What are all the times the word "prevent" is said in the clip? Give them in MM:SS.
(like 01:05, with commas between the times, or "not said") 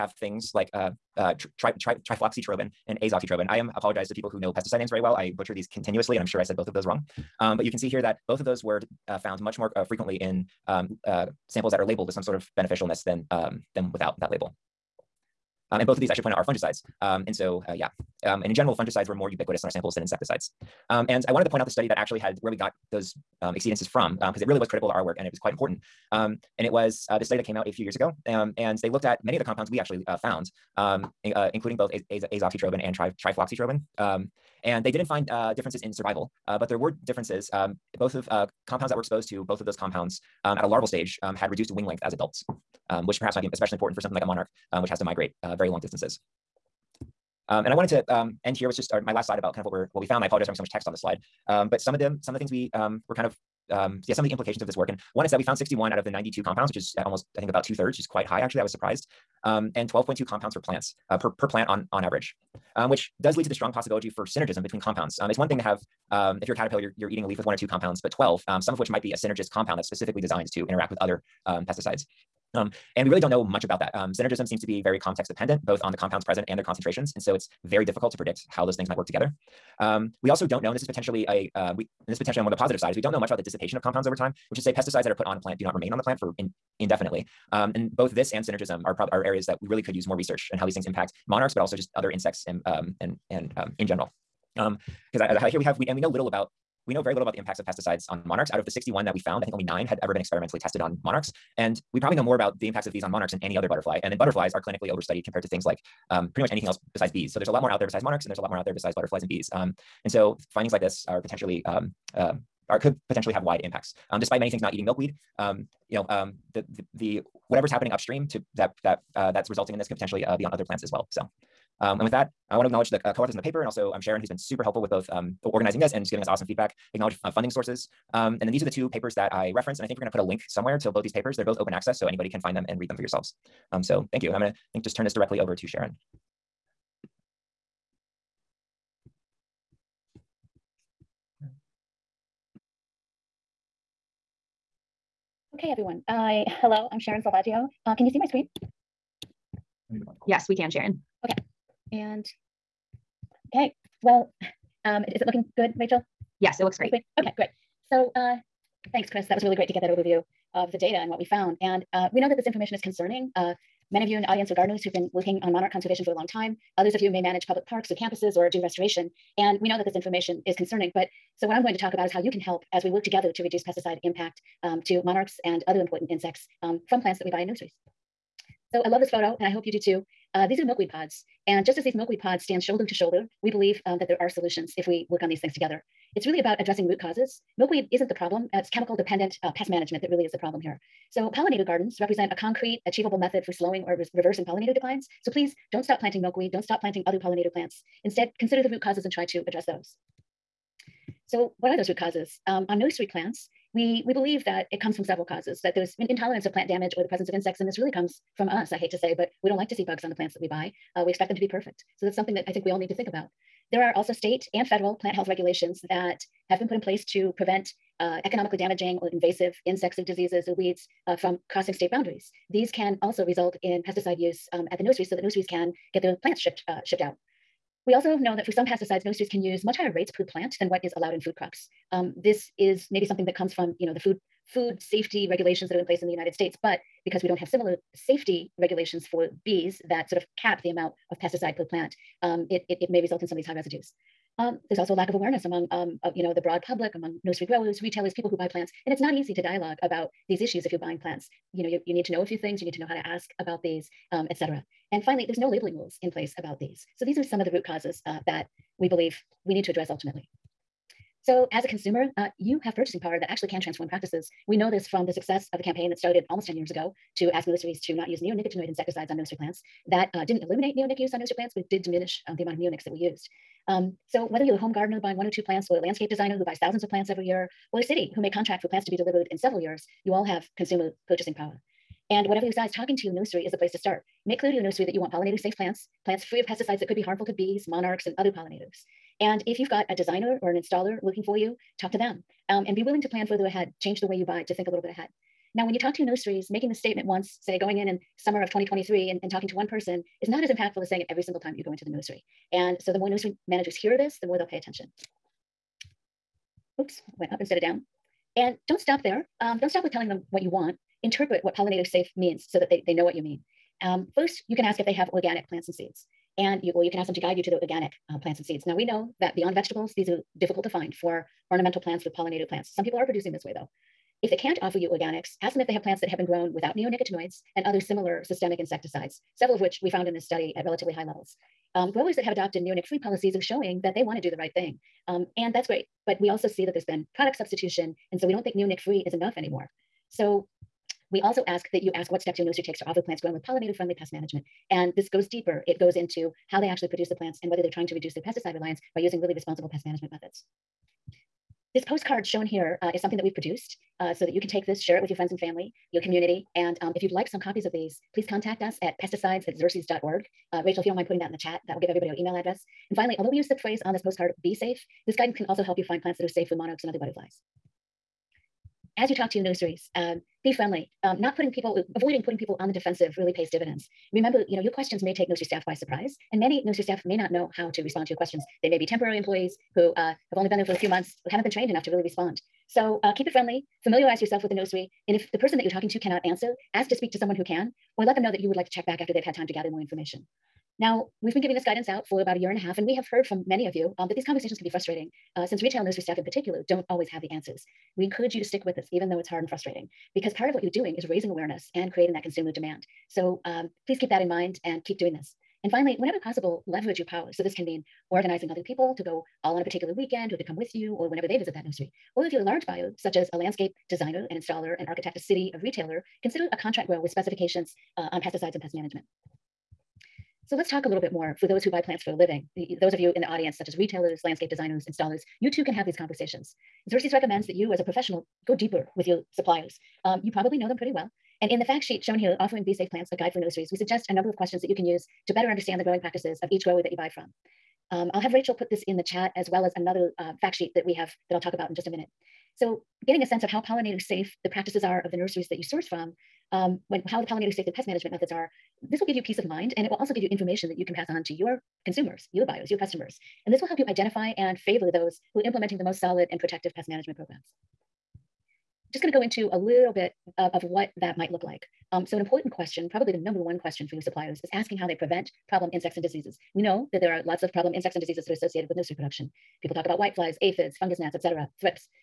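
03:37, 07:44.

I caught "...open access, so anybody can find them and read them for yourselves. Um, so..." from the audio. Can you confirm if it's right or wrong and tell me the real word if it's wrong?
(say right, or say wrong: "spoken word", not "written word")
right.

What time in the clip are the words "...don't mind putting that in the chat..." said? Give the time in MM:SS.
06:00.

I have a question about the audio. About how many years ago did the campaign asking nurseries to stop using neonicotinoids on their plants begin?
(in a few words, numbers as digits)
almost 10 years.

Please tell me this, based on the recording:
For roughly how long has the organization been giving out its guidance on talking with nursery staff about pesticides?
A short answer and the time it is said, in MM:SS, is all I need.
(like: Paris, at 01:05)
about a year and a half, at 06:32.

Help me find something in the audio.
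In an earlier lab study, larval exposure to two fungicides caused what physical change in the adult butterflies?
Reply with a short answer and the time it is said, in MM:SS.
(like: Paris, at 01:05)
reduced wing length, at 00:41.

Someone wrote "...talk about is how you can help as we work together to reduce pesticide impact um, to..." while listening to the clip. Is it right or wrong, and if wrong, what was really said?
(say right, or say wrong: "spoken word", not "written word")
right.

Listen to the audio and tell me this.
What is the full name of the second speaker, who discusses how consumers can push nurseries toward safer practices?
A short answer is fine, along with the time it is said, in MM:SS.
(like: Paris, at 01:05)
Sharon Selvaggio, at 02:26.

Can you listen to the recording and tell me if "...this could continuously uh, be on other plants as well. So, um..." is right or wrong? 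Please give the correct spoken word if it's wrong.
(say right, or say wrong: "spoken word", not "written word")
wrong: "potentially", not "continuously".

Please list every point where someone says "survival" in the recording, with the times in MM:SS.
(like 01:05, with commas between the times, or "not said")
00:35.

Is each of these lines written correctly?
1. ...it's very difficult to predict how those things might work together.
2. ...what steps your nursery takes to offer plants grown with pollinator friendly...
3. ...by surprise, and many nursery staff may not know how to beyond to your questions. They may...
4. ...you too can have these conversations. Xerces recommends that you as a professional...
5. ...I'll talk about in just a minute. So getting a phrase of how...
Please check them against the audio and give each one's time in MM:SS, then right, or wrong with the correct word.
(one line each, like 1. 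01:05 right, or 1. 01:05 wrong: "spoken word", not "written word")
1. 01:17 right
2. 05:42 right
3. 06:15 wrong: "respond", not "beyond"
4. 07:05 right
5. 07:21 wrong: "sense", not "phrase".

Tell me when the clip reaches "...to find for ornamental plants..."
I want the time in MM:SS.
05:20.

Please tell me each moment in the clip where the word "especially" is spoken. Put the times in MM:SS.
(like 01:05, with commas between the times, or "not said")
00:43.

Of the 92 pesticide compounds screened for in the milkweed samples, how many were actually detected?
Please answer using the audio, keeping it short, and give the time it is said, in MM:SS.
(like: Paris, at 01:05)
61, at 00:55.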